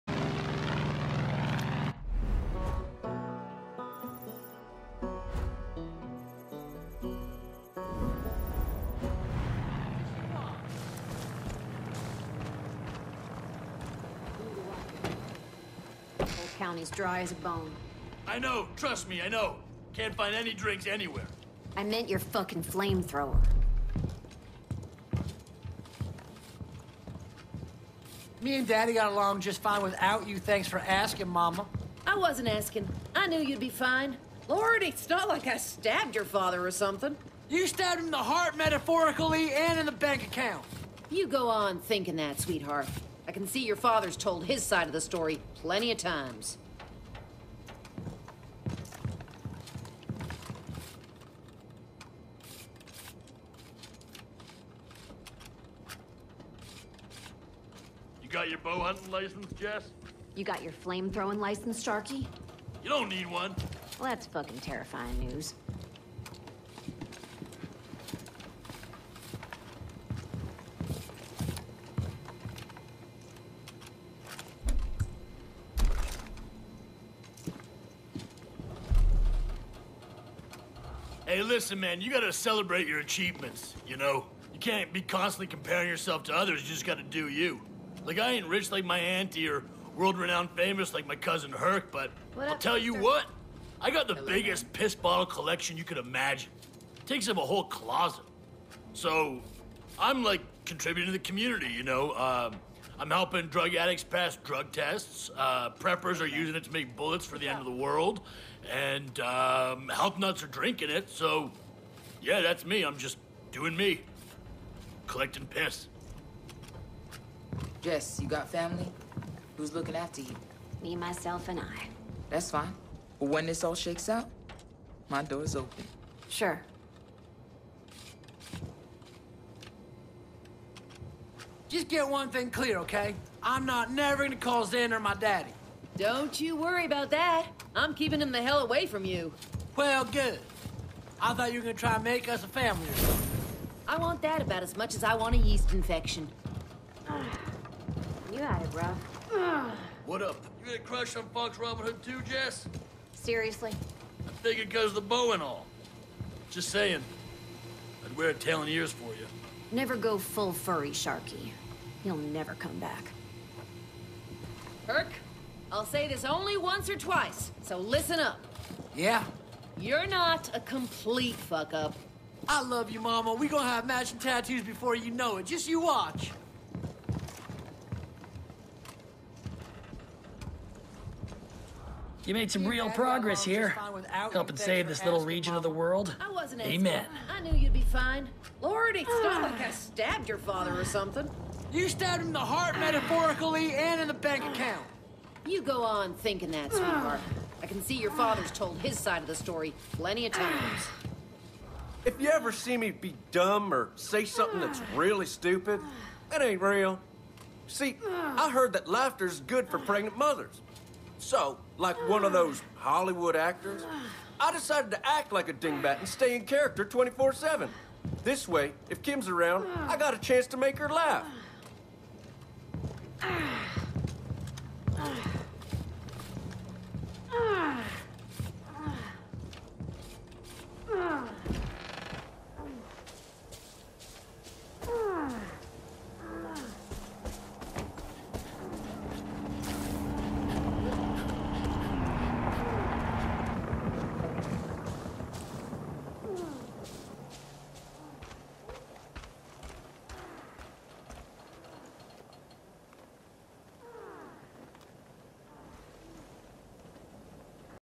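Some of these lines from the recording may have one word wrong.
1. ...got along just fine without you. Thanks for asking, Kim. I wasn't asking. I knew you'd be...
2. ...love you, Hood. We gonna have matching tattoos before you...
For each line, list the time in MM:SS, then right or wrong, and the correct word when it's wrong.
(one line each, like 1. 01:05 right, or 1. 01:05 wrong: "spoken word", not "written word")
1. 00:28 wrong: "Mama", not "Kim"
2. 02:52 wrong: "Mama", not "Hood".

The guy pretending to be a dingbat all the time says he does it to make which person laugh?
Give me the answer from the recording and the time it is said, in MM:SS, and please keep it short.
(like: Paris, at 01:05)
Kim, at 03:39.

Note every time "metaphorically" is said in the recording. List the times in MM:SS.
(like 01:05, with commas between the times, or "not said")
00:38, 03:12.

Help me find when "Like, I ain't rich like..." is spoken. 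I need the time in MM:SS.
01:28.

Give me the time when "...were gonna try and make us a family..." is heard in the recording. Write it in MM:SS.
02:21.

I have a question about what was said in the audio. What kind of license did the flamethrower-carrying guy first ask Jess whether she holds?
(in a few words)
bow hunting.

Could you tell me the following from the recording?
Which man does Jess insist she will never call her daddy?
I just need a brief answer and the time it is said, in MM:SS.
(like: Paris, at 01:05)
Xander, at 02:14.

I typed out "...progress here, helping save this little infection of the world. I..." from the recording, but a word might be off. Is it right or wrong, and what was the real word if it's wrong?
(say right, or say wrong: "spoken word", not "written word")
wrong: "region", not "infection".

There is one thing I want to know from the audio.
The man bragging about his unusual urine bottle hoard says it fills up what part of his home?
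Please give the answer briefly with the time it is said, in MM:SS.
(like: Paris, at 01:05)
A whole closet, at 01:37.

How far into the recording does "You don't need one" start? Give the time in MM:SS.
01:02.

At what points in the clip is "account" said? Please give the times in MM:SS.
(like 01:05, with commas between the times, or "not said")
00:40, 03:14.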